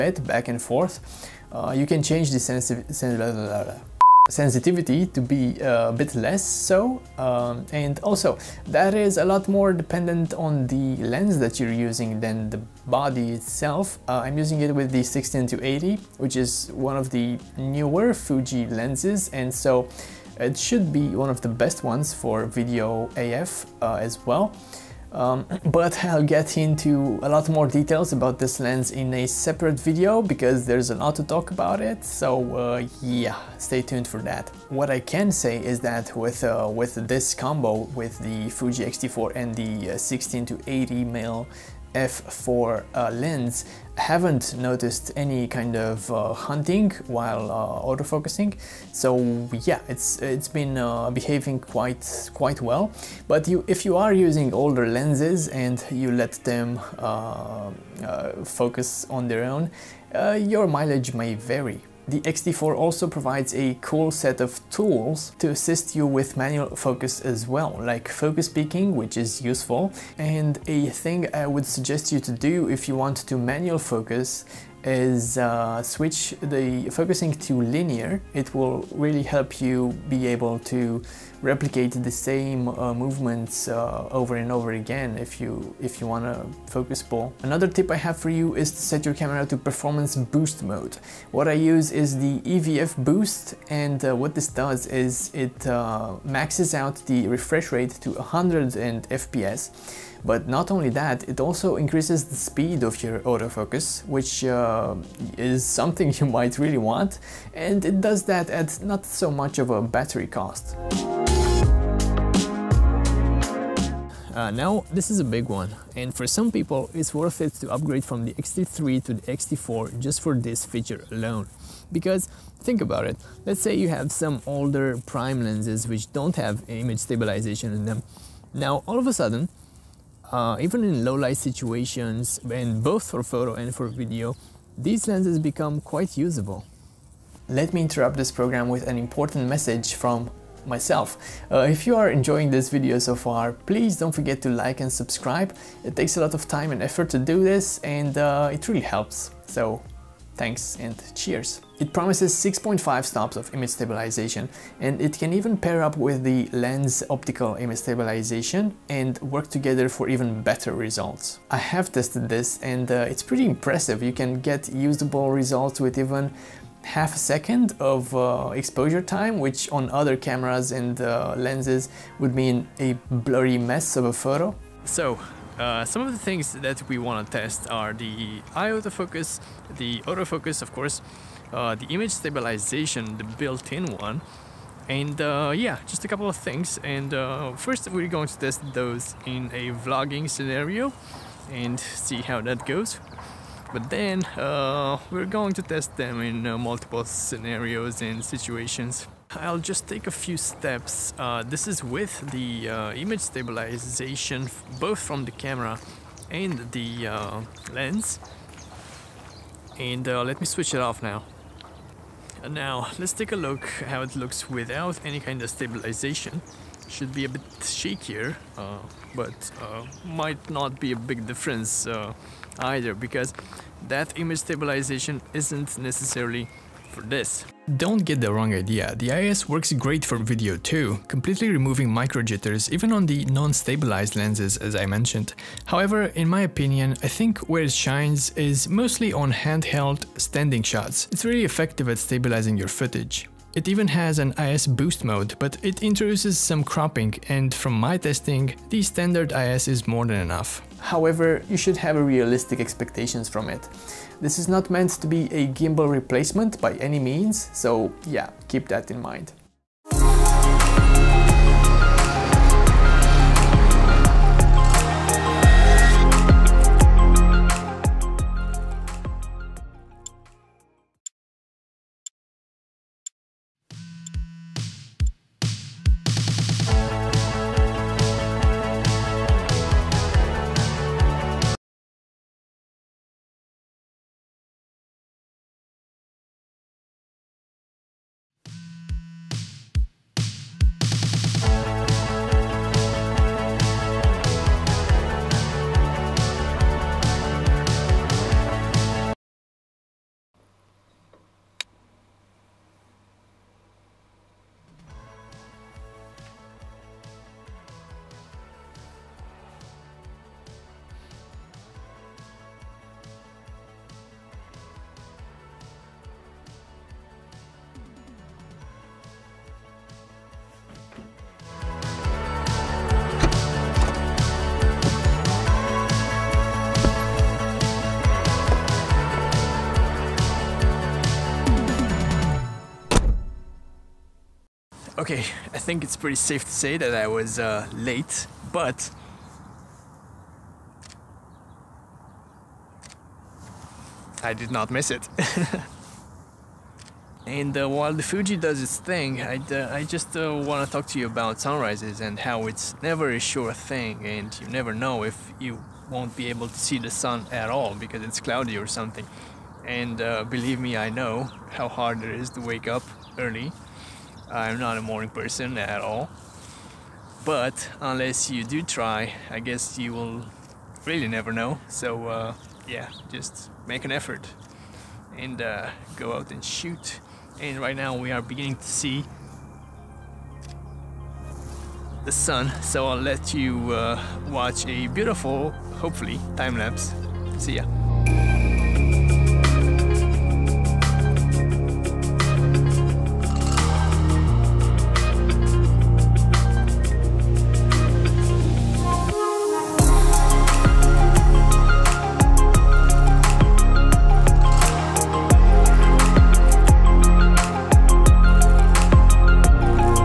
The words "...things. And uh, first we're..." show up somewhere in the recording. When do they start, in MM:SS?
03:06.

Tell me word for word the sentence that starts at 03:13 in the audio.
But then uh, we're going to test them in uh, multiple scenarios and situations.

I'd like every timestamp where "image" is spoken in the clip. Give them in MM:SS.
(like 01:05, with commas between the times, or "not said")
02:06, 02:33, 02:37, 03:01, 03:22, 03:44.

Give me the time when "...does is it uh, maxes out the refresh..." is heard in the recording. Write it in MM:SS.
01:34.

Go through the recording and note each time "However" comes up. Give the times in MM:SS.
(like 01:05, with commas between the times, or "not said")
03:55, 04:10.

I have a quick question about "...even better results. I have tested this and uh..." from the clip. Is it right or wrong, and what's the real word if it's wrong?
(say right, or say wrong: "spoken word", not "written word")
right.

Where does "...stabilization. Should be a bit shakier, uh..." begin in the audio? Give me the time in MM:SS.
03:35.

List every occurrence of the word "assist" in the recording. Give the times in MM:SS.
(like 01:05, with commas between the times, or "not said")
01:05.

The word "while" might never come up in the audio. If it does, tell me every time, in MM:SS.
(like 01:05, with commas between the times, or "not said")
00:47, 05:47.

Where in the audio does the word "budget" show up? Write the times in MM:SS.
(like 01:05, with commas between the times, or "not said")
not said.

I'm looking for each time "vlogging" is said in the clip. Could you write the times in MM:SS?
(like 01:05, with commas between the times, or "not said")
03:09.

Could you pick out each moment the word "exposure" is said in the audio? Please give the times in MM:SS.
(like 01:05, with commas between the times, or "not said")
02:48.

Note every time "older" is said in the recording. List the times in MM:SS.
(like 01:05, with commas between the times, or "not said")
00:54, 02:04.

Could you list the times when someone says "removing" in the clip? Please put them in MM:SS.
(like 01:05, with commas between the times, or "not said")
03:51.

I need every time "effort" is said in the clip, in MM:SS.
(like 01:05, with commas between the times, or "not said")
02:26, 06:13.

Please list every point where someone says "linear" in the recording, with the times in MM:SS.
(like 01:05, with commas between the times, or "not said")
01:17.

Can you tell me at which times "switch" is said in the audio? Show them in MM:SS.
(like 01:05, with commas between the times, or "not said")
01:15, 03:30.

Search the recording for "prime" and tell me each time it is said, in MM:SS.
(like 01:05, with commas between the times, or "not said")
02:05.